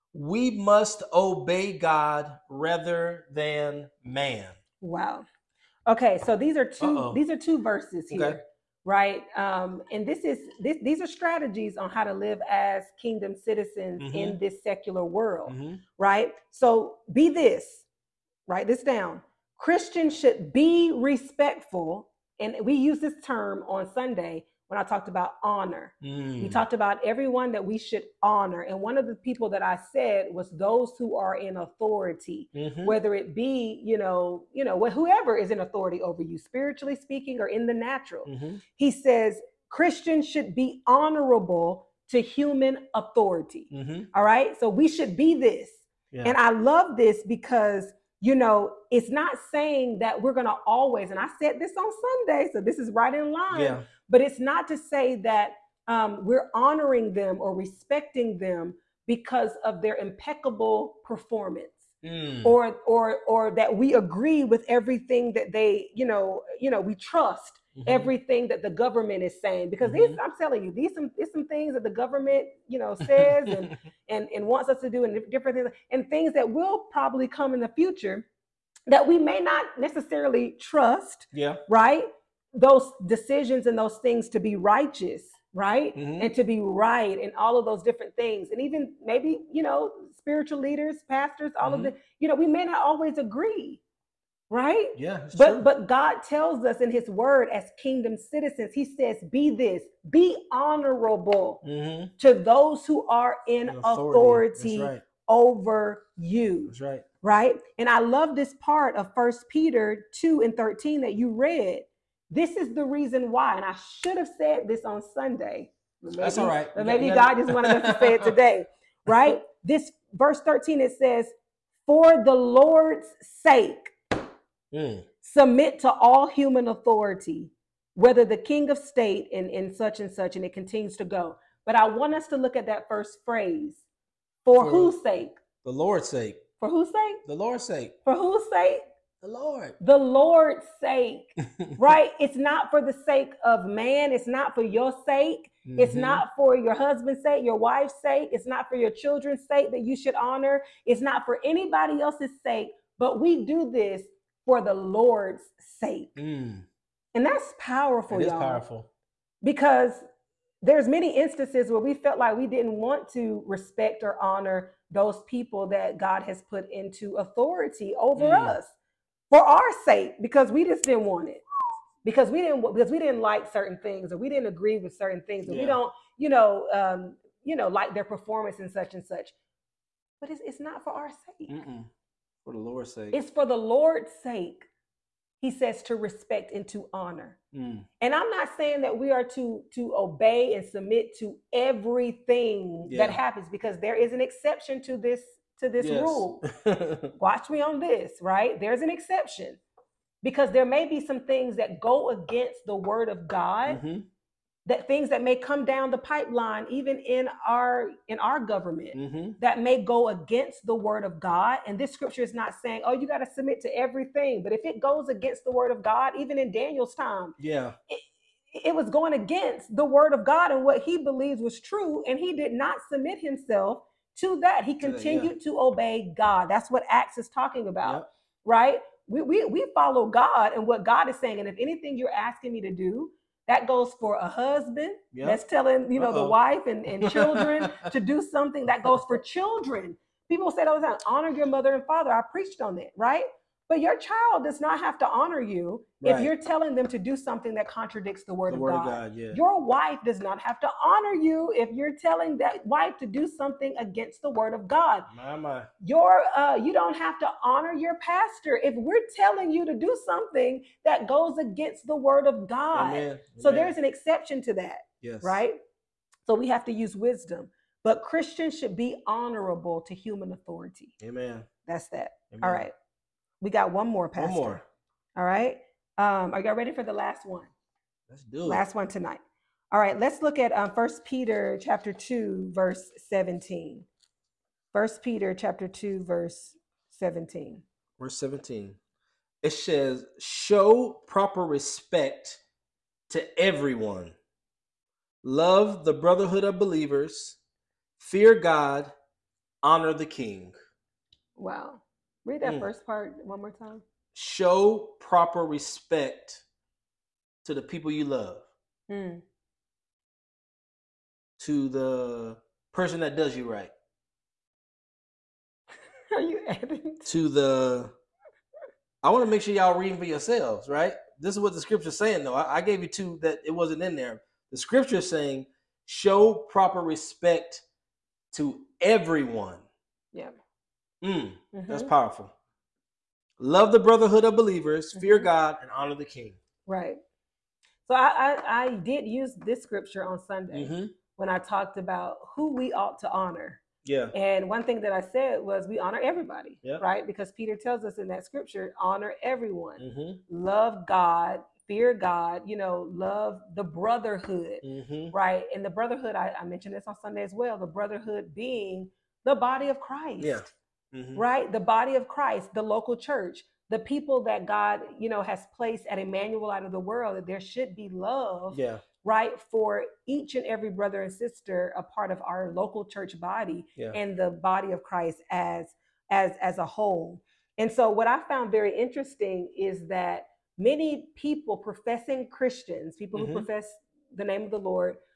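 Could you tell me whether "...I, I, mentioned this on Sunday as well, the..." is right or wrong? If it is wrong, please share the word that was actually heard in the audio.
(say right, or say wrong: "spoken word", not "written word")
right.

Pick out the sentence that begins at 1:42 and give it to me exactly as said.
to those who are in authority, authority right.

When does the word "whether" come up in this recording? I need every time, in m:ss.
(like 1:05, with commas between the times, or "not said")
0:32, 2:07.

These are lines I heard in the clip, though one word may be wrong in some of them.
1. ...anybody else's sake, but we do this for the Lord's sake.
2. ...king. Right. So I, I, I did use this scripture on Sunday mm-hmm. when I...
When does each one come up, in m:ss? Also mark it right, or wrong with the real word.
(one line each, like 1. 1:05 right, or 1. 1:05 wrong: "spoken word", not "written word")
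1. 2:31 right
2. 5:36 right.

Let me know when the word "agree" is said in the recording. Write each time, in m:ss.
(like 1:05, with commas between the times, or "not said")
1:03, 1:33, 2:54.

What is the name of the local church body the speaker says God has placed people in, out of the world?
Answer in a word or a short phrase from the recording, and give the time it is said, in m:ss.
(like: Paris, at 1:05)
Emmanuel, at 6:05.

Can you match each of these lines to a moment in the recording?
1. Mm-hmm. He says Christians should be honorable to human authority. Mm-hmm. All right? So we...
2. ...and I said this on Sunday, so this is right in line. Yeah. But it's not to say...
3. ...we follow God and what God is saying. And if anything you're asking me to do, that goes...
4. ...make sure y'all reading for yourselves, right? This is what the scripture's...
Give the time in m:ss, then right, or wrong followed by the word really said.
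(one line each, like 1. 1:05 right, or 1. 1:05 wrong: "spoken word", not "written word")
1. 0:38 right
2. 0:51 right
3. 3:49 right
4. 5:19 right.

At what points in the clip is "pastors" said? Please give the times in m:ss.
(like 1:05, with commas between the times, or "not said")
1:31, 4:17, 4:34.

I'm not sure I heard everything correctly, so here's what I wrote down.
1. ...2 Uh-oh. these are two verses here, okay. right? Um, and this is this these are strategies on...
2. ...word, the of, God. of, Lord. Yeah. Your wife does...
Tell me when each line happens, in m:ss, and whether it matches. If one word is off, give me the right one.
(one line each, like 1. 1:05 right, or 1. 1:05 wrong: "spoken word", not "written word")
1. 0:06 right
2. 4:08 wrong: "God", not "Lord".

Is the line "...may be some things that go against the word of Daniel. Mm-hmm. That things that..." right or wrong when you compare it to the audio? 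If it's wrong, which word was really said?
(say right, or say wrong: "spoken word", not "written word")
wrong: "God", not "Daniel".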